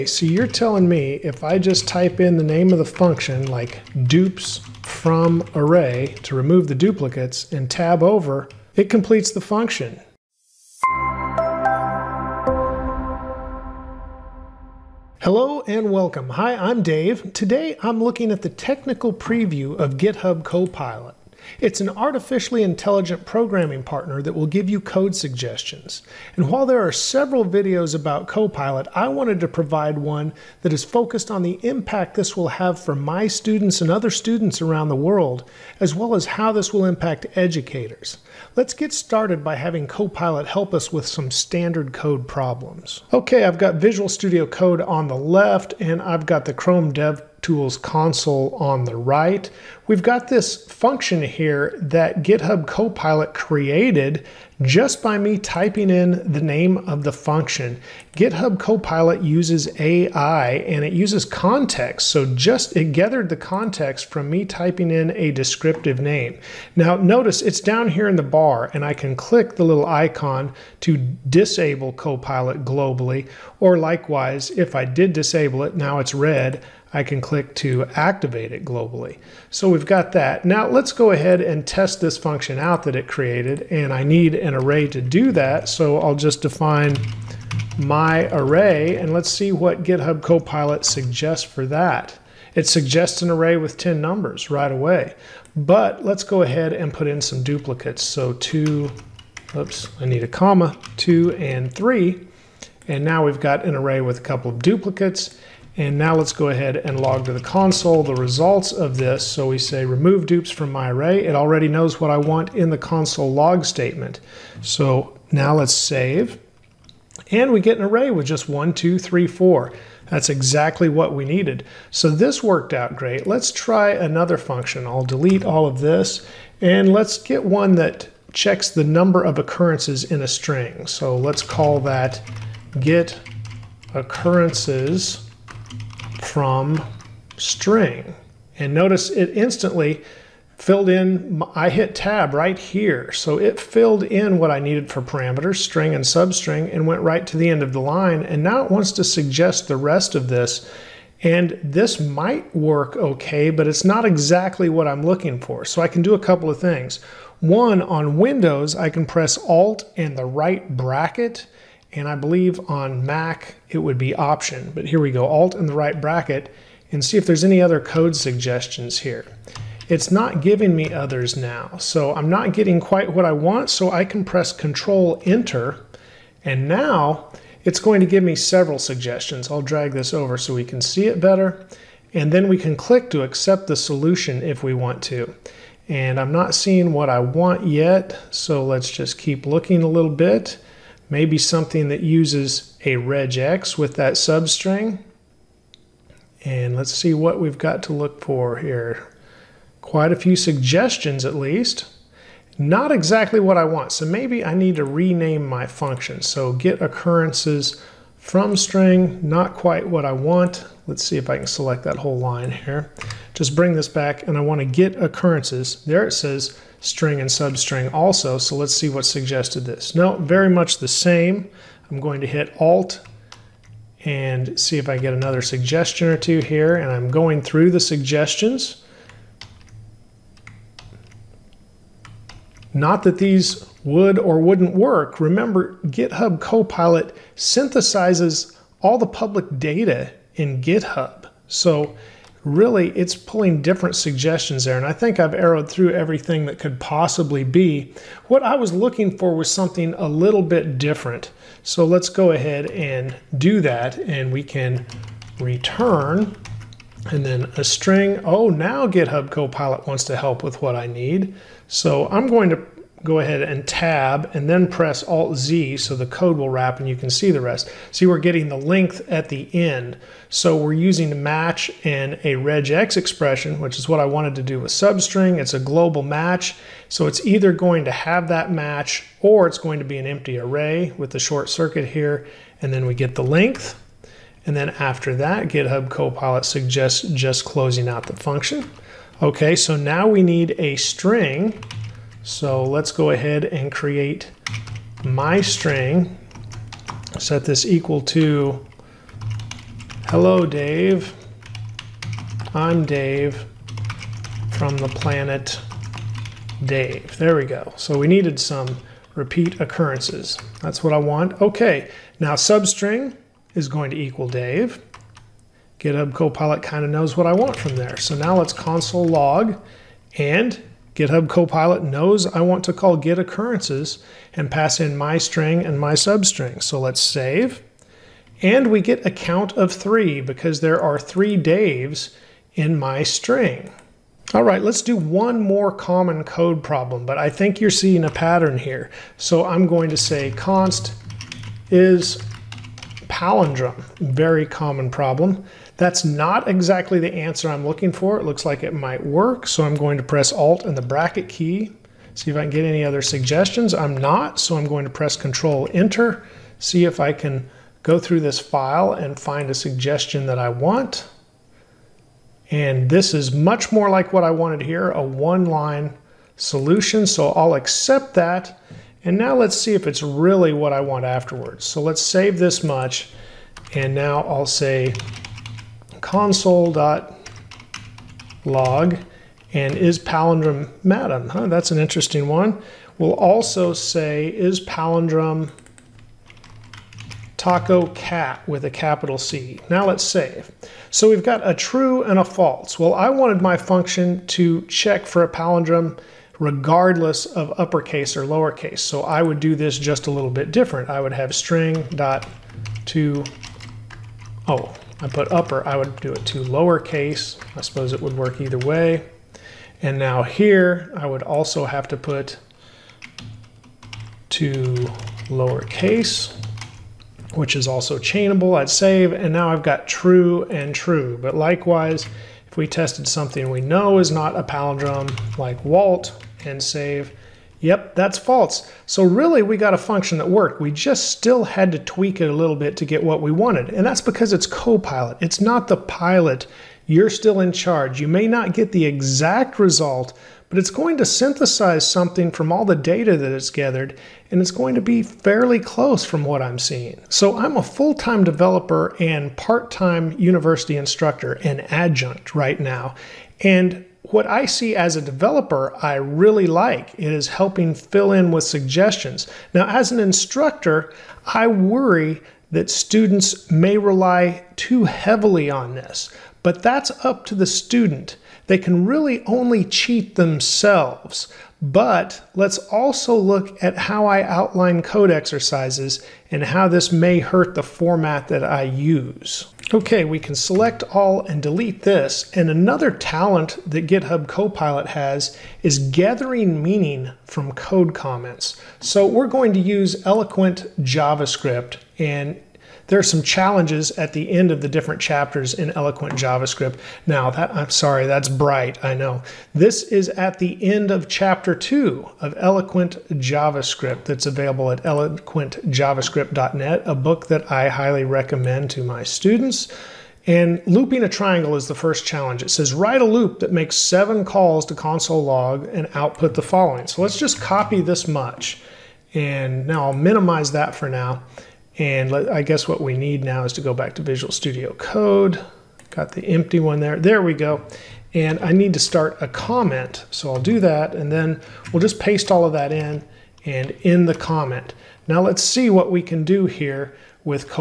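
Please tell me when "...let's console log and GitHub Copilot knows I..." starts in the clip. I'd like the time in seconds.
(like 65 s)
318 s.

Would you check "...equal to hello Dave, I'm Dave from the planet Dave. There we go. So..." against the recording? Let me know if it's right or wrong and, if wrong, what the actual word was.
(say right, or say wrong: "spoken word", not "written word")
right.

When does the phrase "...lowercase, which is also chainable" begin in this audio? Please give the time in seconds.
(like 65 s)
415 s.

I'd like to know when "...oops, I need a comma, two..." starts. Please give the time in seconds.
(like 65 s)
99 s.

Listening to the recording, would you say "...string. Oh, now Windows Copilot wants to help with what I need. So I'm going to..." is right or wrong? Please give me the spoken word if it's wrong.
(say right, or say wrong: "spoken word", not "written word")
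wrong: "GitHub", not "Windows".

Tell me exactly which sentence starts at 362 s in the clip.
And this is much more like what I wanted here, a one-line solution, so I'll accept that.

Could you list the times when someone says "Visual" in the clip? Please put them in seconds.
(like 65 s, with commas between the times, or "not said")
43 s, 524 s.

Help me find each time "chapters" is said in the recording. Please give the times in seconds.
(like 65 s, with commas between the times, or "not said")
495 s, 501 s.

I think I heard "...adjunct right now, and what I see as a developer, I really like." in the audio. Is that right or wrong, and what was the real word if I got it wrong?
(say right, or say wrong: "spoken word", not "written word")
right.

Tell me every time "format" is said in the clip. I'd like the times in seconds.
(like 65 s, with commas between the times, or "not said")
477 s.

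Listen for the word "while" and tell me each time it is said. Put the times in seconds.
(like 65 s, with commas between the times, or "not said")
26 s.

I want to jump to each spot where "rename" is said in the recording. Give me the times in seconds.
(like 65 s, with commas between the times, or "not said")
204 s.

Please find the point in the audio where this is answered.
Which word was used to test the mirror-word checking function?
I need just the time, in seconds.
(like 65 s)
387 s.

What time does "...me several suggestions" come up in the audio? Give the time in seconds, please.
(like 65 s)
178 s.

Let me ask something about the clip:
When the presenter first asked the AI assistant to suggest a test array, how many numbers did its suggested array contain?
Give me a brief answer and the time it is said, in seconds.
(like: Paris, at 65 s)
10, at 93 s.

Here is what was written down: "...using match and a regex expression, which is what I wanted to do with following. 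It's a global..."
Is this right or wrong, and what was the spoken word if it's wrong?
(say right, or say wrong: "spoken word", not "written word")
wrong: "substring", not "following".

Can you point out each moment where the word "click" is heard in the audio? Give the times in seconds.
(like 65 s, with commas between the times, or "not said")
69 s, 77 s, 182 s.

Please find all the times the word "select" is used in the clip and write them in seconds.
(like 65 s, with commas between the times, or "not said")
211 s, 480 s.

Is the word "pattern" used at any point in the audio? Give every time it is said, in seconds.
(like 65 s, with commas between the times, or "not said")
338 s.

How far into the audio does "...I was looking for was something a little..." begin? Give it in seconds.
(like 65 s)
248 s.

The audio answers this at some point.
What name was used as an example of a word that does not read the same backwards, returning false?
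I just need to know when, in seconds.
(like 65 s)
425 s.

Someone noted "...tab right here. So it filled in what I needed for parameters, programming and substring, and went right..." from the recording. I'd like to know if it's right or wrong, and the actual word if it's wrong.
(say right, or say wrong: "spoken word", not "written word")
wrong: "string", not "programming".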